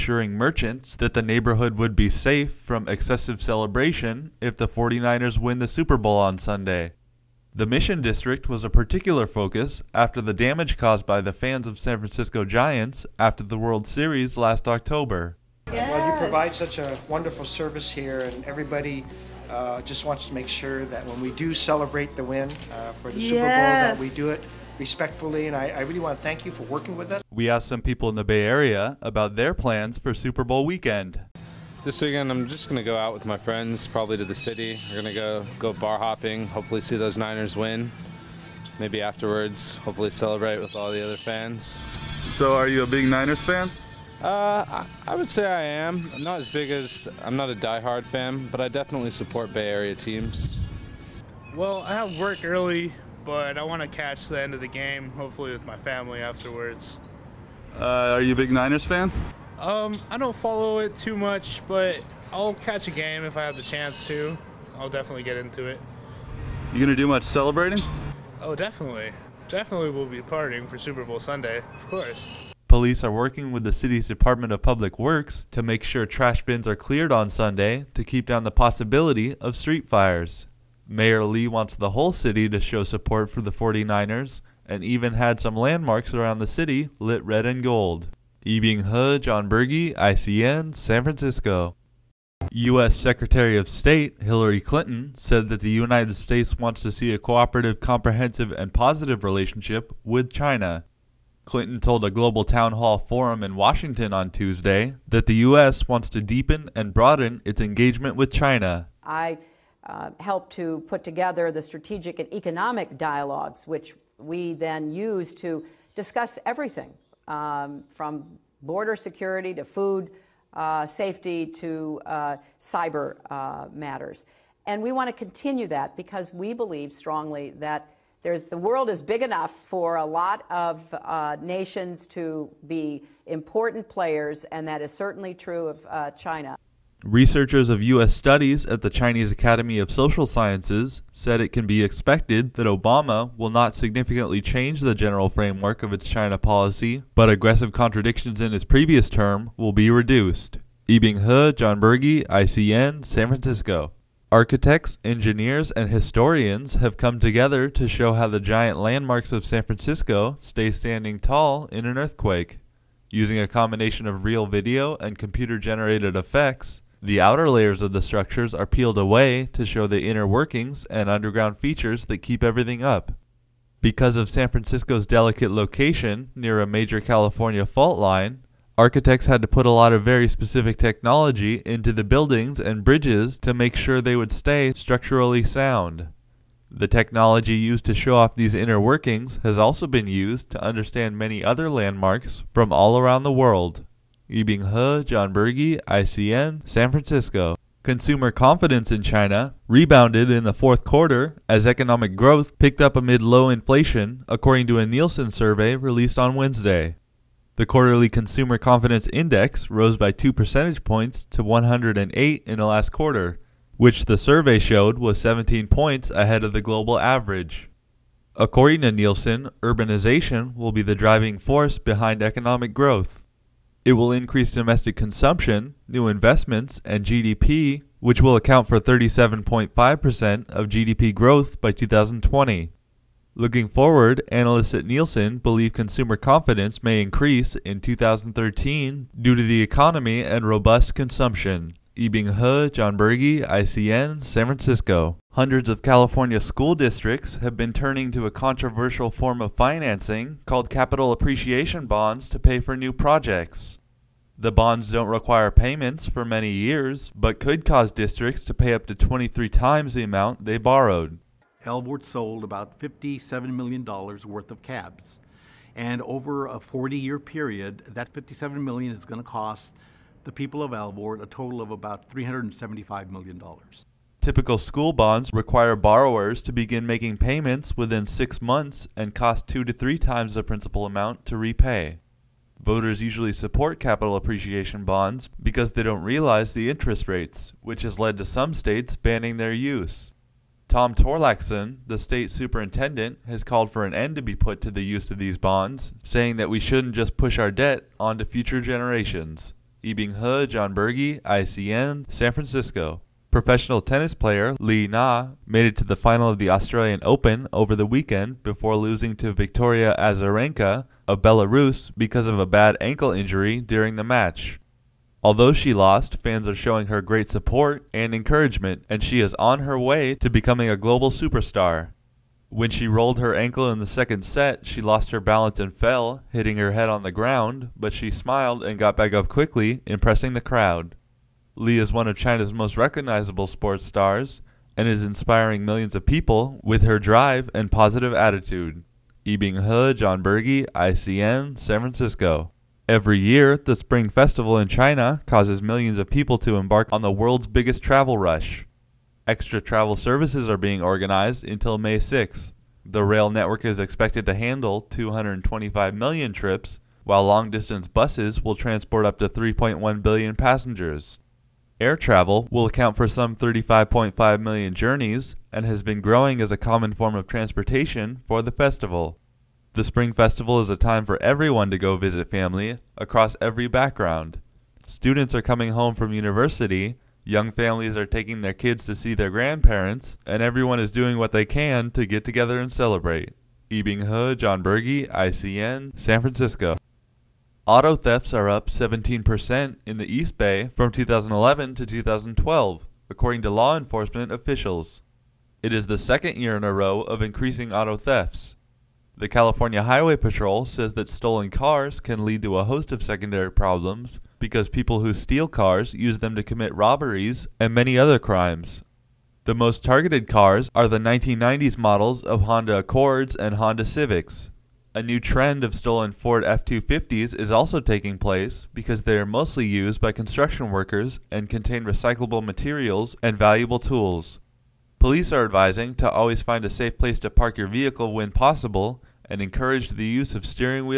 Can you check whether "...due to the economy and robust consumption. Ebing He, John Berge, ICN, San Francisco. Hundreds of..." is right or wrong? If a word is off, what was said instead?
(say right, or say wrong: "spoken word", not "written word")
right.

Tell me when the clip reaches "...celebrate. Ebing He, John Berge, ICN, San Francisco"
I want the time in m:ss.
6:22.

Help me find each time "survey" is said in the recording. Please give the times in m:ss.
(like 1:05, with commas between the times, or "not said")
3:25, 3:34.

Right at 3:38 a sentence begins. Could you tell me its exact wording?
According to Nielsen, urbanization will be the driving force behind economic growth.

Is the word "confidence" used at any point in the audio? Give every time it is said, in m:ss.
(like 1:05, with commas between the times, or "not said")
3:18, 3:28, 3:56.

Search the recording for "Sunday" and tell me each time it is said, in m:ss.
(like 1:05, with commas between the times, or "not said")
0:06, 1:11, 1:17.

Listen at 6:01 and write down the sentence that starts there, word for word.
Air travel will account for some 35.5 million journeys and has been growing as a common form of transportation for the festival.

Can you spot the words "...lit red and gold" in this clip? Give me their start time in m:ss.
1:26.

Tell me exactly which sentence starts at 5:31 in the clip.
Li is one of China's most recognizable sports stars and is inspiring millions of people with her drive and positive attitude.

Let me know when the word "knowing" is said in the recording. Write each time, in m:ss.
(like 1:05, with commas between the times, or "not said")
not said.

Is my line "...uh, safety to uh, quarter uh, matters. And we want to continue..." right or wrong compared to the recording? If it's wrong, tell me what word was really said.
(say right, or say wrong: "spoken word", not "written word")
wrong: "cyber", not "quarter".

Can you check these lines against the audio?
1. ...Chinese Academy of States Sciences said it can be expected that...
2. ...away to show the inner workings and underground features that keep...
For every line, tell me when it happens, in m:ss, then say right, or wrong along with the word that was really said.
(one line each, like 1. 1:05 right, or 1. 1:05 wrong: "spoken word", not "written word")
1. 2:18 wrong: "Social", not "States"
2. 2:48 right.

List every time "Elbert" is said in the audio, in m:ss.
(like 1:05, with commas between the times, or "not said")
4:21, 4:30.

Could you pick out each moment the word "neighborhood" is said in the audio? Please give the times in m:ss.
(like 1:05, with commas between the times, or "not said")
0:01.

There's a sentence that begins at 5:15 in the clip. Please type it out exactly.
Although she lost, fans are showing her great support and encouragement, and she is on her way to becoming a global superstar.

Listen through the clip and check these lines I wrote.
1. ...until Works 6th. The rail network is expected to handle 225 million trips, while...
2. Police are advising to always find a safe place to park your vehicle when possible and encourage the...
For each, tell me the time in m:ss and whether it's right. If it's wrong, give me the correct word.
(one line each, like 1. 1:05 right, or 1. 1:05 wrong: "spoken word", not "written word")
1. 5:51 wrong: "May", not "Works"
2. 7:04 right.